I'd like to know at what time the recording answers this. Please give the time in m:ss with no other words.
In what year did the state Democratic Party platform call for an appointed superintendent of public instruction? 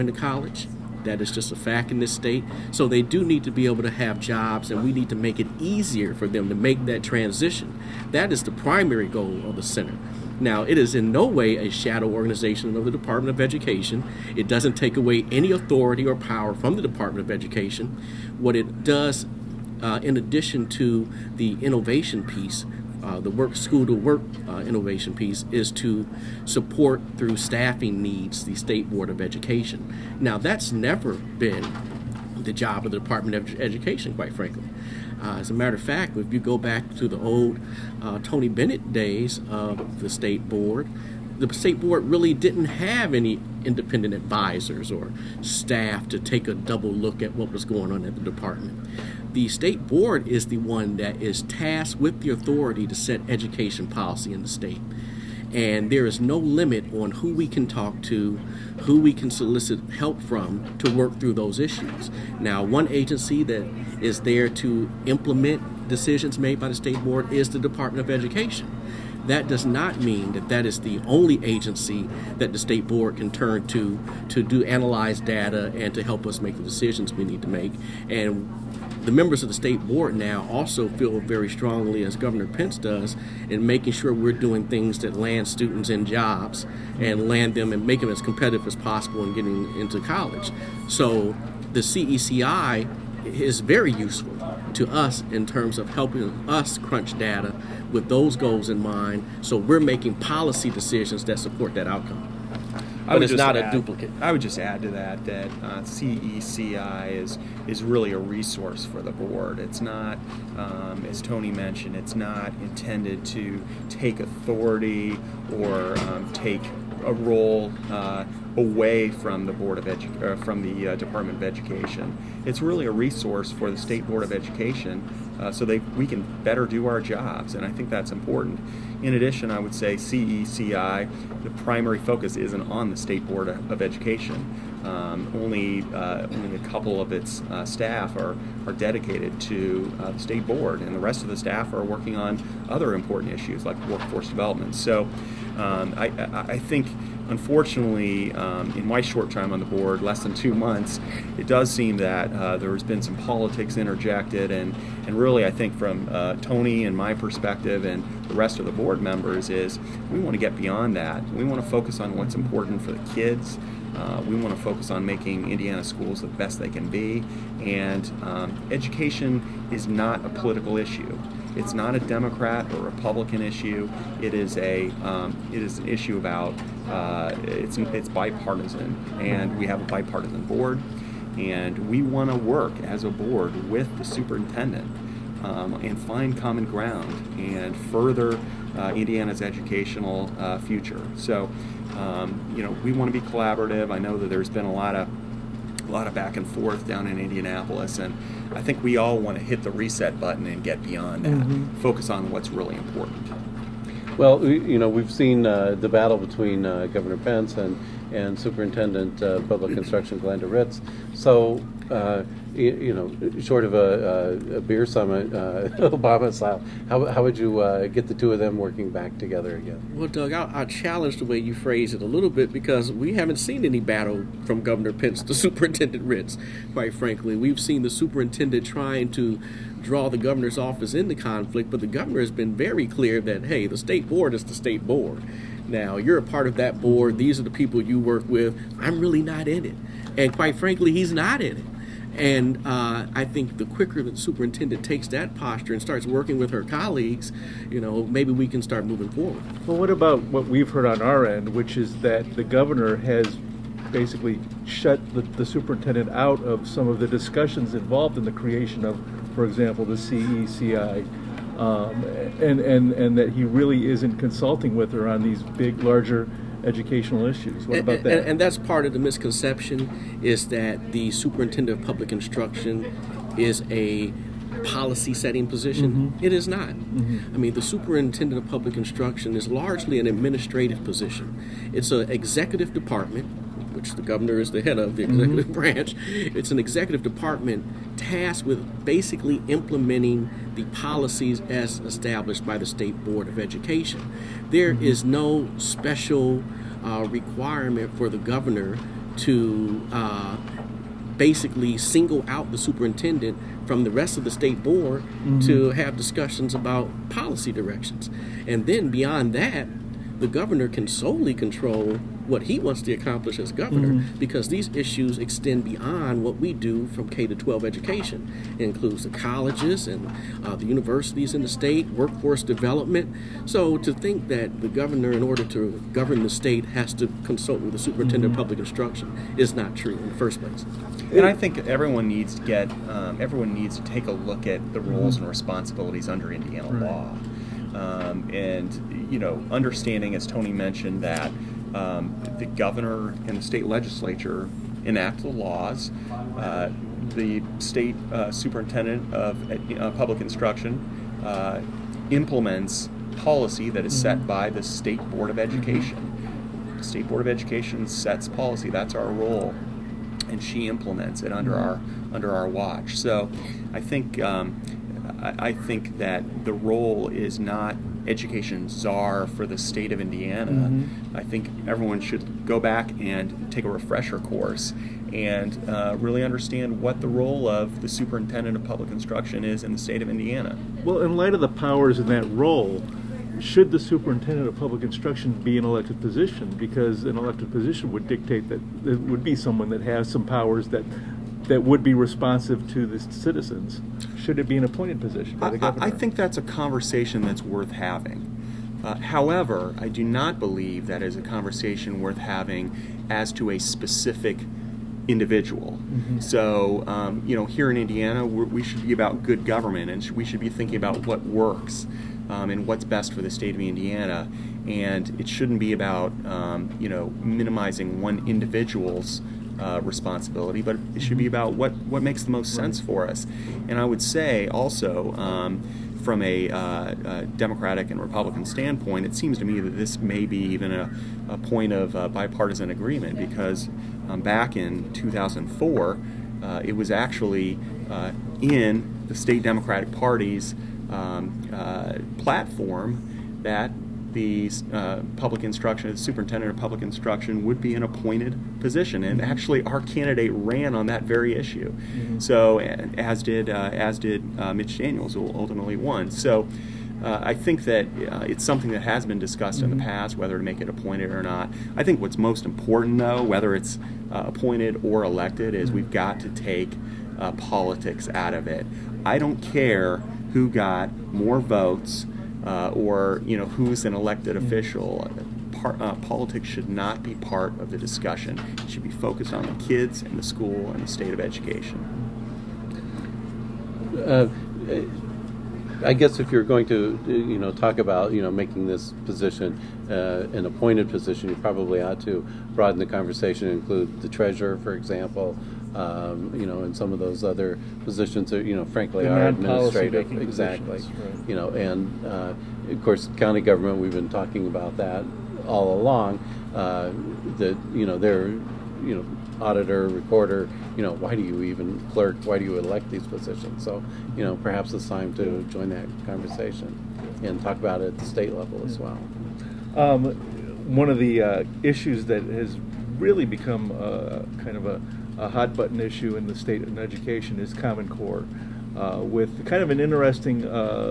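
7:14.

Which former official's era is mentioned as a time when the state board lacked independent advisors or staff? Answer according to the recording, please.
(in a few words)
Tony Bennett.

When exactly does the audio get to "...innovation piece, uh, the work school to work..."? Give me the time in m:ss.
0:21.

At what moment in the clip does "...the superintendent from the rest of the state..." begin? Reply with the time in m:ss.
5:02.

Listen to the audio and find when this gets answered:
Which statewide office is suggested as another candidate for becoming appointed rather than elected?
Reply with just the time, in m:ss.
8:14.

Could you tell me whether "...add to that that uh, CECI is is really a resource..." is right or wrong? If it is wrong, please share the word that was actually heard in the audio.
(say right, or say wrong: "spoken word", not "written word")
right.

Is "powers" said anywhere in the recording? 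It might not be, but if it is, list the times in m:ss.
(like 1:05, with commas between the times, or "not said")
0:16, 6:21, 6:30.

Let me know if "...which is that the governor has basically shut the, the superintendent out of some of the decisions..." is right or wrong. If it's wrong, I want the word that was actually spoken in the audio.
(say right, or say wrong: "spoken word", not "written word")
wrong: "discussions", not "decisions".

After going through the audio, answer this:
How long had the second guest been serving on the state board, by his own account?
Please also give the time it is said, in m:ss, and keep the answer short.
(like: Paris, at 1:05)
less than two months, at 2:30.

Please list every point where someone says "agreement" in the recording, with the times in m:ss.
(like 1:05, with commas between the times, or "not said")
7:12.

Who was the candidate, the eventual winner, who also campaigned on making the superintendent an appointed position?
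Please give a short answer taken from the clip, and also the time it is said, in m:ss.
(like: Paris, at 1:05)
Mitch Daniels, at 7:34.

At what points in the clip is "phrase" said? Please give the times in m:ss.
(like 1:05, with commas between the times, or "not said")
3:41.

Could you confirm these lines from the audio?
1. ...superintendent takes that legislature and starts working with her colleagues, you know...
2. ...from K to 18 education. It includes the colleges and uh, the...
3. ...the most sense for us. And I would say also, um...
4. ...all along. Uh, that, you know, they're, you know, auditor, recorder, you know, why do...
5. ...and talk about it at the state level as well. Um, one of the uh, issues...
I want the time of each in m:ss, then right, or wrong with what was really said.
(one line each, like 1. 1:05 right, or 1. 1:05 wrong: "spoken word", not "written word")
1. 4:04 wrong: "posture", not "legislature"
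2. 5:16 wrong: "12", not "18"
3. 7:02 right
4. 8:25 right
5. 8:37 right.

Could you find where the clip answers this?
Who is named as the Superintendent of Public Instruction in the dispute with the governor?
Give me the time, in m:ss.
3:30.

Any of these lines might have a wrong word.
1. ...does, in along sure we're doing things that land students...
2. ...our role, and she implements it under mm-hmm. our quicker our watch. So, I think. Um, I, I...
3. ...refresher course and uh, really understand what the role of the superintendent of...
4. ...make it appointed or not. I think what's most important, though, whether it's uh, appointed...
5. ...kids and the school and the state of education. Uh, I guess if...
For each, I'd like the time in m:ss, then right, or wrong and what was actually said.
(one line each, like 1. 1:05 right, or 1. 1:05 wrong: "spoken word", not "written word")
1. 1:22 wrong: "making", not "along"
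2. 5:58 wrong: "under", not "quicker"
3. 6:13 right
4. 7:40 right
5. 7:59 right.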